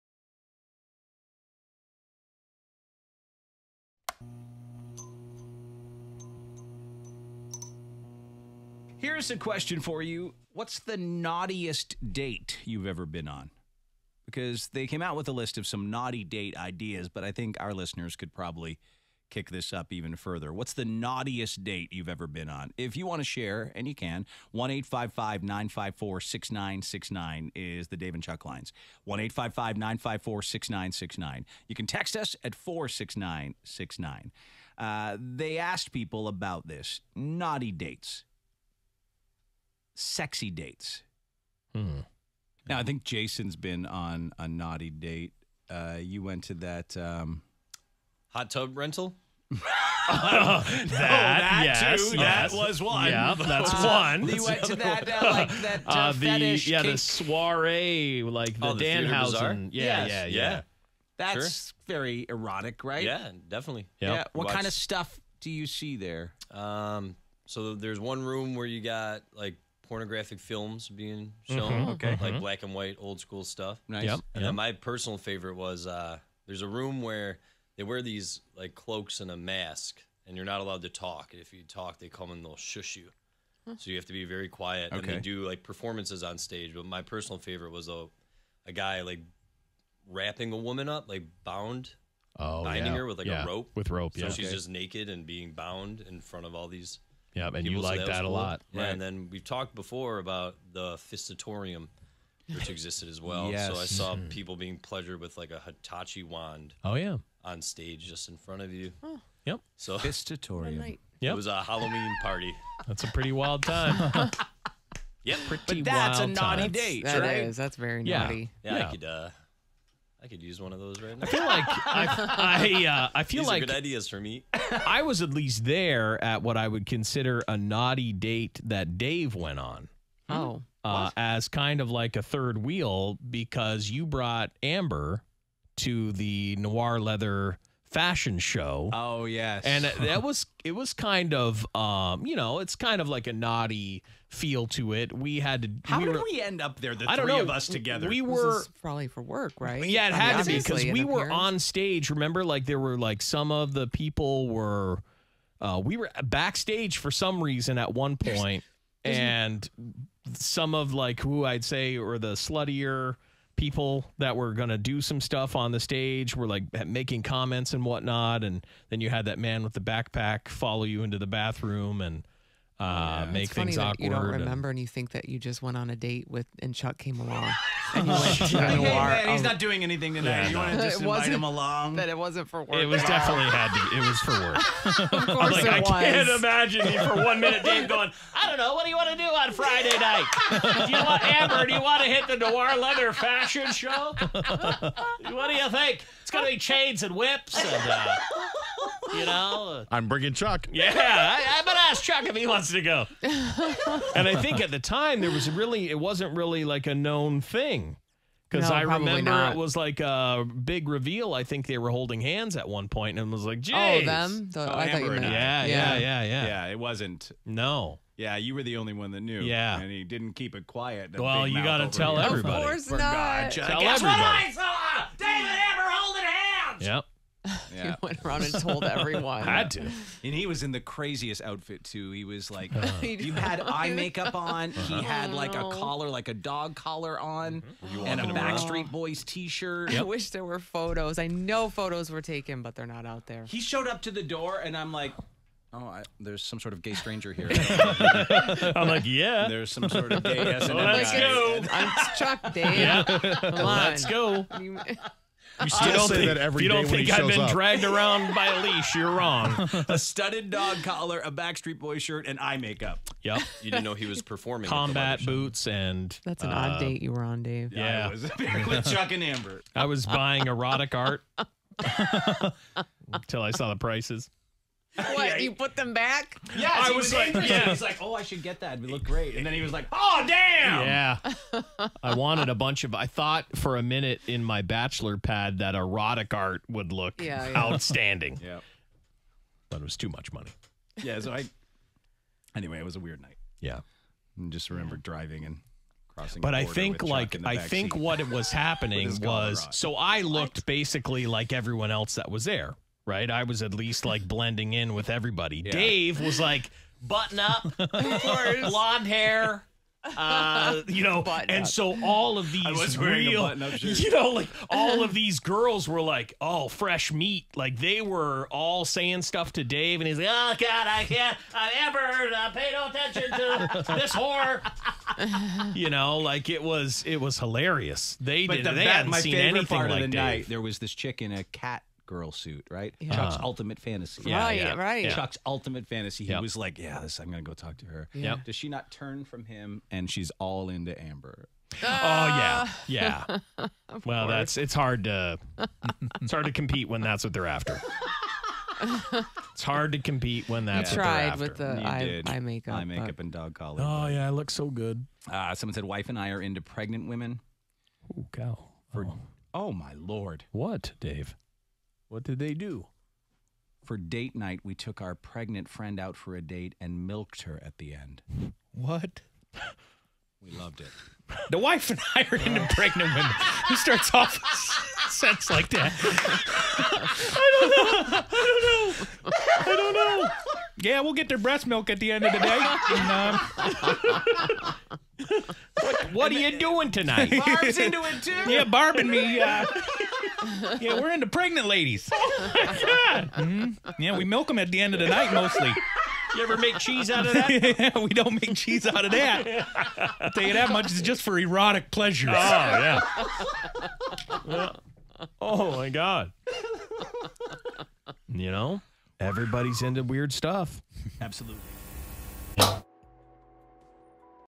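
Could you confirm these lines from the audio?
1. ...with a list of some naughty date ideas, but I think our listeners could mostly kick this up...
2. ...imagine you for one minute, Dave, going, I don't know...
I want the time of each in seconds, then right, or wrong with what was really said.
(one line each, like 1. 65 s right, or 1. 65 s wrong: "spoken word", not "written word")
1. 15 s wrong: "probably", not "mostly"
2. 186 s right.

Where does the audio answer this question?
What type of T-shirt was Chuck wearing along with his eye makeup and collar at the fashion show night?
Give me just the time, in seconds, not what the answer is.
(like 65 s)
238 s.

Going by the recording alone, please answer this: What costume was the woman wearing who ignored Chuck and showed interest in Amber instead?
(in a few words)
cat girl suit.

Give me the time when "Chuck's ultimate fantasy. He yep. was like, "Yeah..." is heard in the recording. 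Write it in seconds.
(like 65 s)
335 s.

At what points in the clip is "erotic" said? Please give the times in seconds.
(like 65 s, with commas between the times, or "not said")
62 s, 270 s, 285 s, 401 s.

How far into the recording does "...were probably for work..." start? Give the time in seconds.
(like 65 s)
148 s.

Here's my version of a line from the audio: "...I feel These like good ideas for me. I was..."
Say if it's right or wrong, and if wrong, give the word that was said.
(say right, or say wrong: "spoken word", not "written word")
right.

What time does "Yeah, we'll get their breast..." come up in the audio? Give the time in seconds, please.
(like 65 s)
380 s.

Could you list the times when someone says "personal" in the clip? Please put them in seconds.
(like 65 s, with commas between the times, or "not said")
74 s, 87 s.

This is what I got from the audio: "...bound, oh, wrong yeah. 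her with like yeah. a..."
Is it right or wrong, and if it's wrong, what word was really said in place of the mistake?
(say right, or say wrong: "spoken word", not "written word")
wrong: "binding", not "wrong".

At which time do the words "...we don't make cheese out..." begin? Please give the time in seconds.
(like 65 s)
397 s.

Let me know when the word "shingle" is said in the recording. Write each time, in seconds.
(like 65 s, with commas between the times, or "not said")
not said.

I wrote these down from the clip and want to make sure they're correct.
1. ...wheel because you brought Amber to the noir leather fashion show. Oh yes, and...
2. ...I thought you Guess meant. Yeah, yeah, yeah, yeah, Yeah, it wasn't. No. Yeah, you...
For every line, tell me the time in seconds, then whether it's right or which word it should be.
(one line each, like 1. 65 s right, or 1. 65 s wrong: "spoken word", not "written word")
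1. 132 s right
2. 214 s wrong: "Amber", not "Guess".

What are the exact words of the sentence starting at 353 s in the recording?
Oh yeah, I look so good.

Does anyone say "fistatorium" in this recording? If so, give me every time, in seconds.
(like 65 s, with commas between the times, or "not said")
100 s, 109 s.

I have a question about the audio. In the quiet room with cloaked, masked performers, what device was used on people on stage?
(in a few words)
Hitachi wand.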